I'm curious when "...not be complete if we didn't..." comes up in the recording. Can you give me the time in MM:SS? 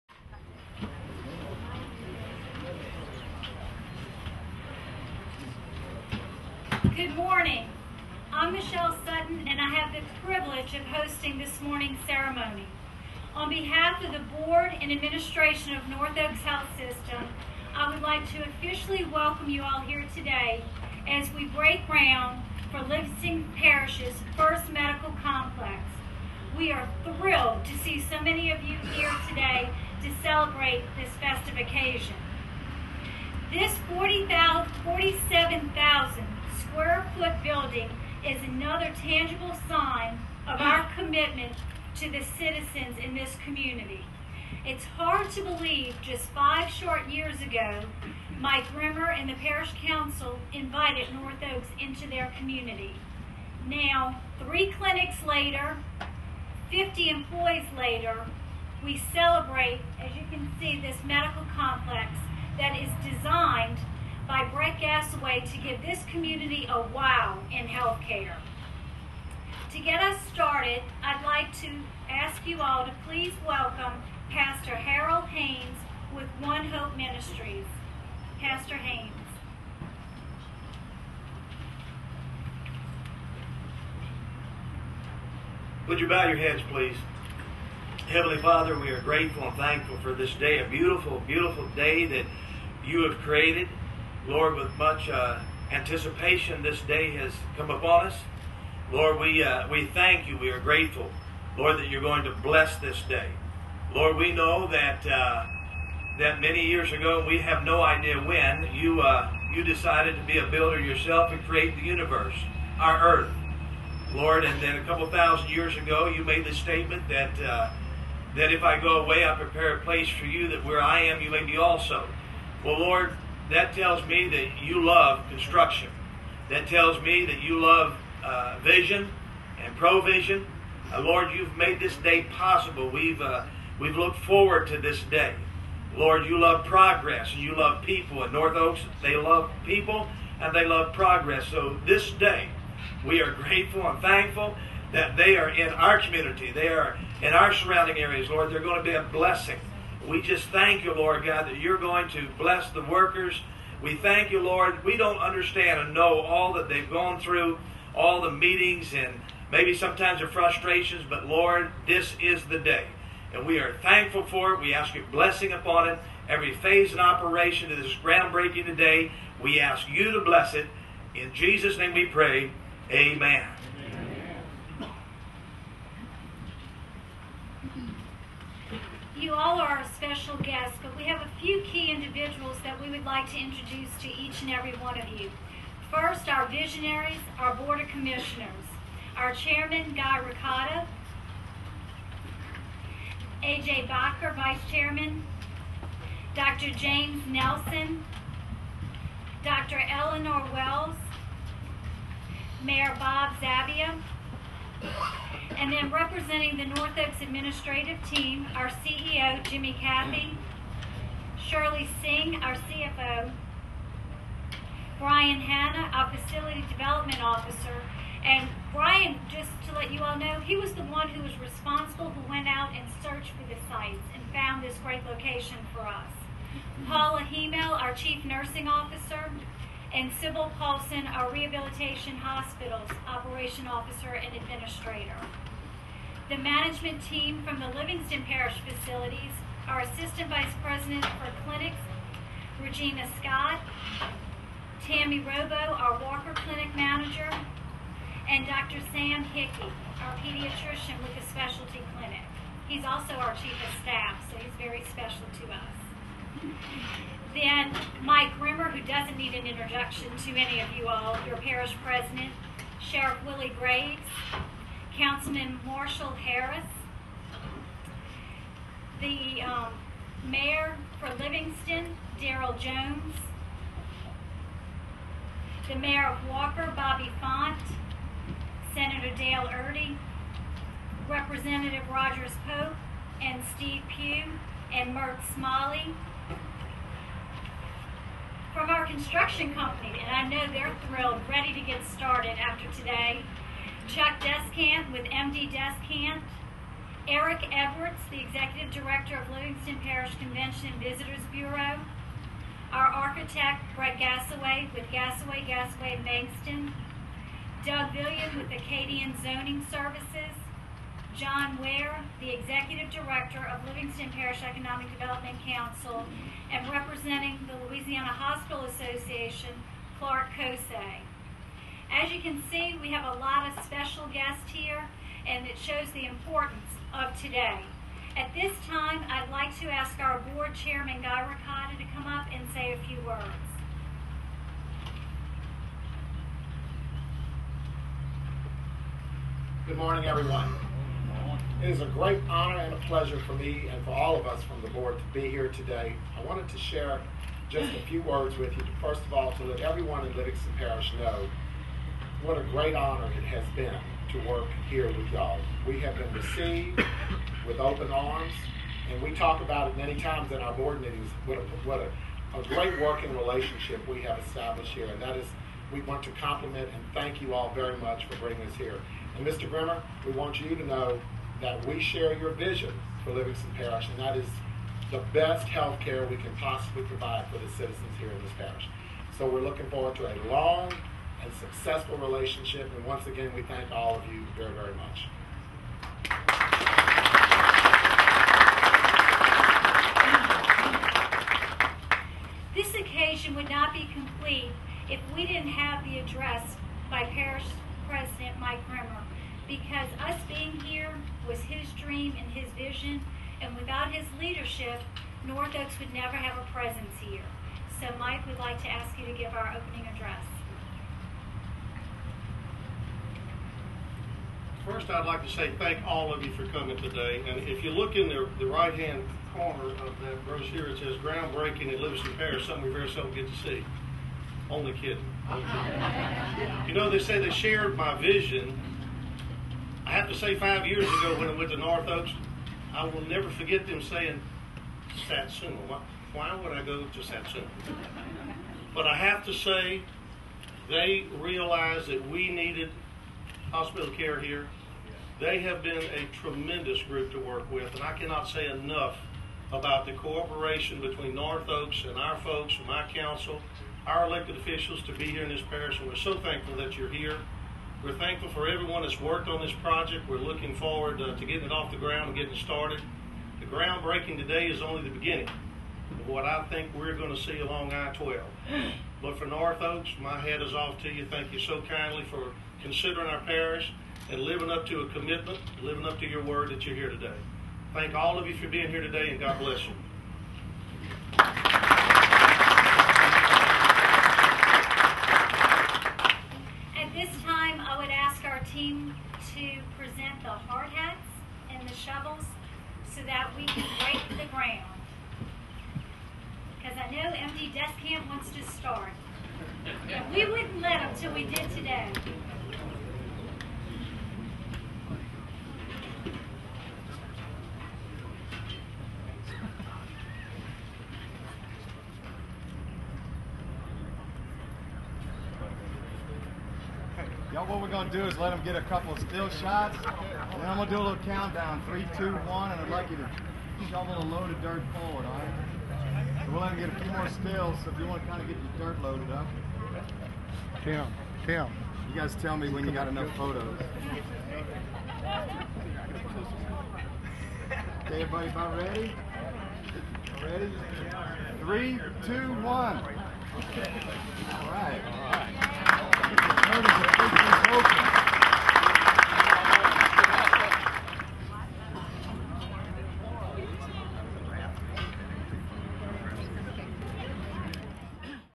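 06:33.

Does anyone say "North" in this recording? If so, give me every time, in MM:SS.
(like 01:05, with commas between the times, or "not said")
00:15, 00:51, 02:18, 03:26, 06:45, 07:11, 07:31, 07:49.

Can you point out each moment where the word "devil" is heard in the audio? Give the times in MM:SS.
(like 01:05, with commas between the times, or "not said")
not said.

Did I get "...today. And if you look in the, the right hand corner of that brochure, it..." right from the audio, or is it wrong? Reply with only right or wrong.
right.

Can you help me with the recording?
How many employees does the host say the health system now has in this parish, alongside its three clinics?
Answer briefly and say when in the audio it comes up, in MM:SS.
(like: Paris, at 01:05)
50, at 00:56.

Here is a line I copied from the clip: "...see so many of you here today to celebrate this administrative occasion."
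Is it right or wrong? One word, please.
wrong.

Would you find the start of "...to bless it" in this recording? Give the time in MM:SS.
02:50.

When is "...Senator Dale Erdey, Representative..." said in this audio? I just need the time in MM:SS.
04:38.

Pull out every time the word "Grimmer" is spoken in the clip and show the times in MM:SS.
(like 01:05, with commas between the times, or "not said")
00:48, 04:18, 06:09, 06:38.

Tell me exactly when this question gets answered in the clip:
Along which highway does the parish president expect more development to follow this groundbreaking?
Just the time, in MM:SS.
07:47.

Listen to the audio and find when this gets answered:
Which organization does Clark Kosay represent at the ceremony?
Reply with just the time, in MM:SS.
05:17.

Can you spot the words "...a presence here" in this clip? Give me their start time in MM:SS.
06:46.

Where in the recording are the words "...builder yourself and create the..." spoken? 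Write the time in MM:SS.
01:50.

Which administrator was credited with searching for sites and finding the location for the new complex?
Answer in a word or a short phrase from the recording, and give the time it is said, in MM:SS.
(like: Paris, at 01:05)
Brian Hanna, at 03:34.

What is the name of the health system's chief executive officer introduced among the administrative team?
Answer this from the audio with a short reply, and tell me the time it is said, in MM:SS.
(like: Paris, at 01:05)
Jimmy Cathey, at 03:29.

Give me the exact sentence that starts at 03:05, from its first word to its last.
First, our visionaries, our Board of Commissioners, our Chairman, Guy Ricotta, A.J.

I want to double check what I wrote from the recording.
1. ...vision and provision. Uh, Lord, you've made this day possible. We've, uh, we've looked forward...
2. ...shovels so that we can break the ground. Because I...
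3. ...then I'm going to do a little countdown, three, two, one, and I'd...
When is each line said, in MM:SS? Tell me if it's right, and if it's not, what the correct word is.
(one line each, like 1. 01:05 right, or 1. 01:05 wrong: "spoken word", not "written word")
1. 02:08 right
2. 08:11 right
3. 08:40 right.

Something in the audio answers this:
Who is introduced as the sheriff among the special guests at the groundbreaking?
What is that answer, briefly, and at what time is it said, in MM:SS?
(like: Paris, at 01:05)
Willie Graves, at 04:23.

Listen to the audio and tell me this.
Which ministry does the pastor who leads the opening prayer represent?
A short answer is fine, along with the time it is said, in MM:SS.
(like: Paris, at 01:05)
One Hope Ministries, at 01:16.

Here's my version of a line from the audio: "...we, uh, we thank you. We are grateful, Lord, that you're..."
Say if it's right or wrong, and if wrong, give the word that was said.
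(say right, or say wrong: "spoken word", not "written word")
right.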